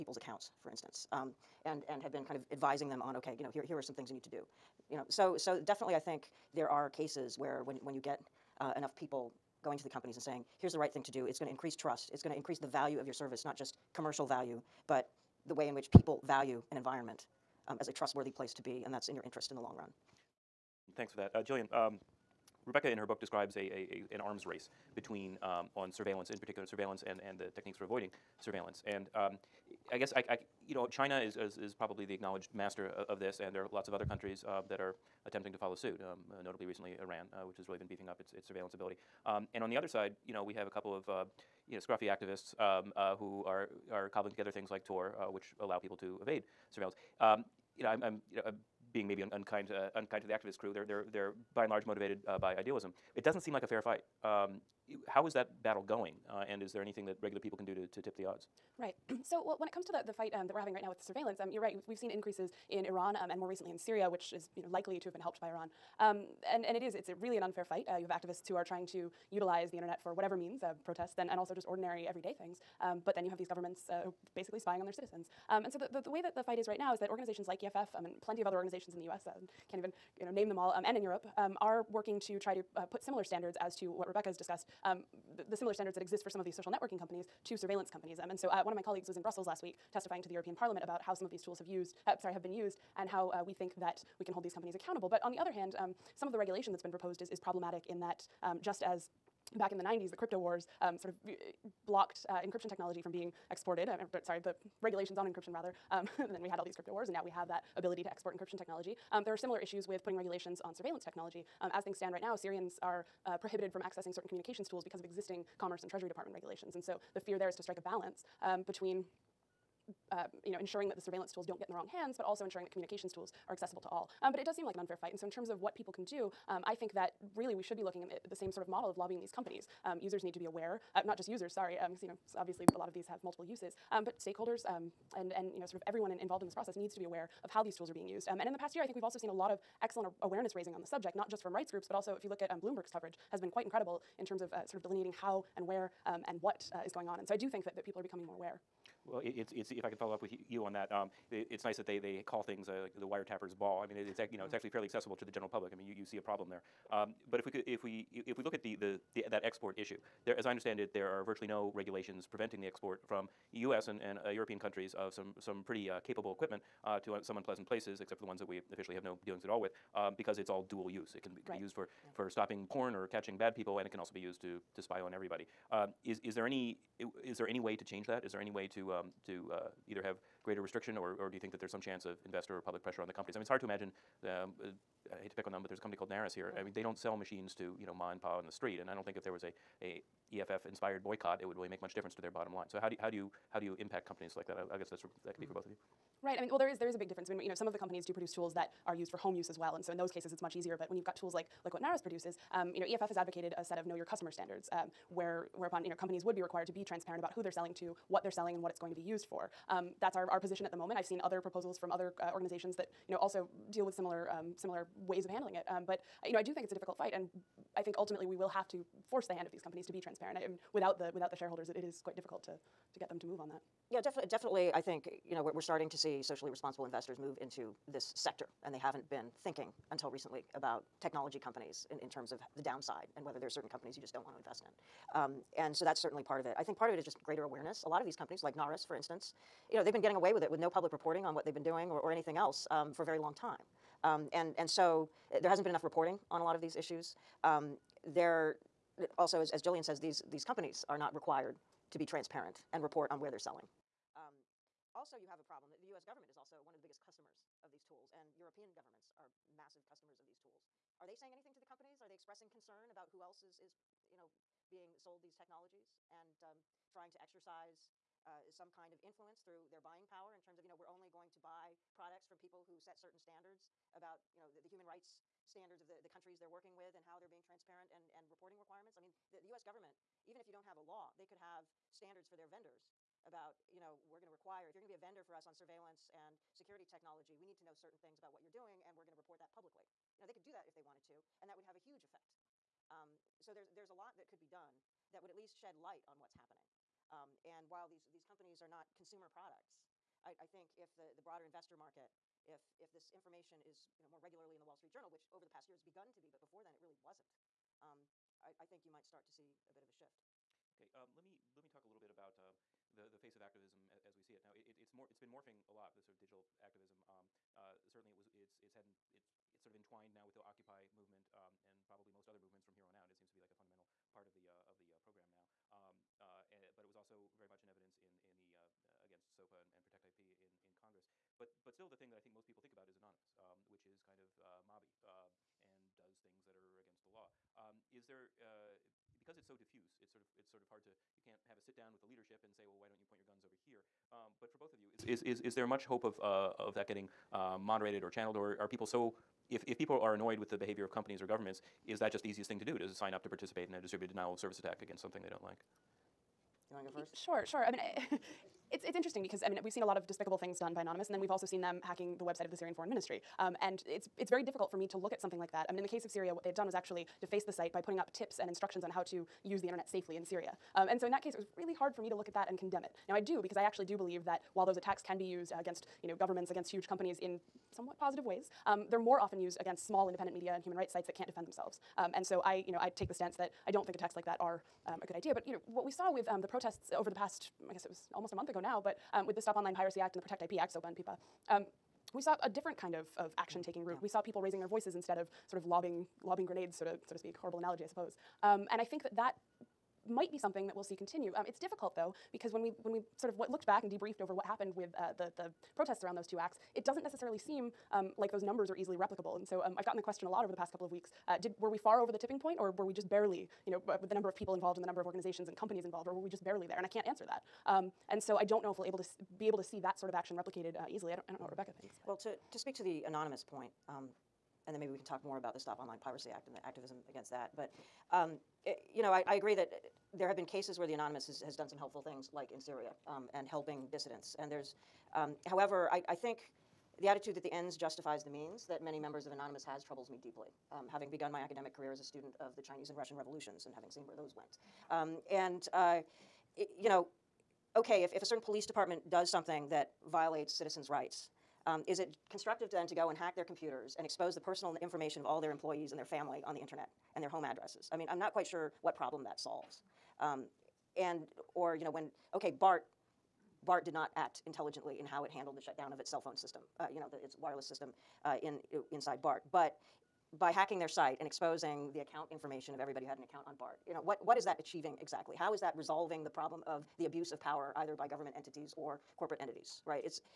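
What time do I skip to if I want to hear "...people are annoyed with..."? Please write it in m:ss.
5:49.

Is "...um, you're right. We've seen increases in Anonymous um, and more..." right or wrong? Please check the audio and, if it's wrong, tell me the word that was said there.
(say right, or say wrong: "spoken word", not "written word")
wrong: "Iran", not "Anonymous".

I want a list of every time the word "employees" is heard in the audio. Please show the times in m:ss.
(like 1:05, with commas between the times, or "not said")
7:35.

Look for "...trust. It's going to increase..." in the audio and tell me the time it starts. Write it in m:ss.
0:11.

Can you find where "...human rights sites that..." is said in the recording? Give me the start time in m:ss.
6:20.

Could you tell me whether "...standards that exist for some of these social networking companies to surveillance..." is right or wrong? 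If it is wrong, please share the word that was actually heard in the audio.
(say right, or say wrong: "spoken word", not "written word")
right.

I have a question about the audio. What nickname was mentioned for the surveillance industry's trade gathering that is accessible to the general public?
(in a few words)
The wiretappers ball.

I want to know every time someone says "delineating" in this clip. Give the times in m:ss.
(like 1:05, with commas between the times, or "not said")
2:24.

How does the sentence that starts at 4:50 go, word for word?
You know, they could do that if they wanted to, and that would have a huge effect.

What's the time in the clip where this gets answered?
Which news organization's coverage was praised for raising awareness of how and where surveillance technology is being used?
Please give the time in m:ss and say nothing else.
2:22.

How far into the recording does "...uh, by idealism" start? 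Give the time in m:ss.
0:52.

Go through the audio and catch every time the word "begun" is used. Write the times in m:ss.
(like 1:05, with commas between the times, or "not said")
5:05, 7:21.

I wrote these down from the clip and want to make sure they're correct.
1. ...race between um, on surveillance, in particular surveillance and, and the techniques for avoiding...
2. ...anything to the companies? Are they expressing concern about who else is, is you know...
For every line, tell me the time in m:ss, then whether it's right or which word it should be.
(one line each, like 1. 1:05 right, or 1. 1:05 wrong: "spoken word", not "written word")
1. 0:24 right
2. 4:21 right.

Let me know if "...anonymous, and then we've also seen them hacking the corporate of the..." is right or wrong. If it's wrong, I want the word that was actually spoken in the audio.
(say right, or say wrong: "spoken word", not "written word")
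wrong: "website", not "corporate".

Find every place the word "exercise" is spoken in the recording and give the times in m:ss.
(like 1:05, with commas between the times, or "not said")
4:27.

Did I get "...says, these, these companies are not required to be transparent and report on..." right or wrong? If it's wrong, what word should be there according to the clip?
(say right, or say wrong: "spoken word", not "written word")
right.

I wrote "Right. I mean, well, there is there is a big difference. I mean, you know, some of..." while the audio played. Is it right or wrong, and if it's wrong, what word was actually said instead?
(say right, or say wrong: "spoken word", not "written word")
right.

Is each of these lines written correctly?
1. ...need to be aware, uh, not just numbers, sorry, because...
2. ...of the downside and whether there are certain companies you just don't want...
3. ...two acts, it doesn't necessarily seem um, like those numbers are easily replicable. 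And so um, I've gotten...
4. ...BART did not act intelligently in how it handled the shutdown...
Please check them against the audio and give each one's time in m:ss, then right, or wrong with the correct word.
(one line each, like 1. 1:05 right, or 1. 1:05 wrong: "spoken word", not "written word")
1. 2:10 wrong: "users", not "numbers"
2. 3:52 right
3. 6:46 right
4. 7:43 right.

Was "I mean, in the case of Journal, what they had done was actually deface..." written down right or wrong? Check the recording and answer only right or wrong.
wrong.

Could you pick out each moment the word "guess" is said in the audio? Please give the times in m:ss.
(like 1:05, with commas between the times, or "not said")
0:29, 3:14, 6:27.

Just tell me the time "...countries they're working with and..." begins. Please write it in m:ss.
4:36.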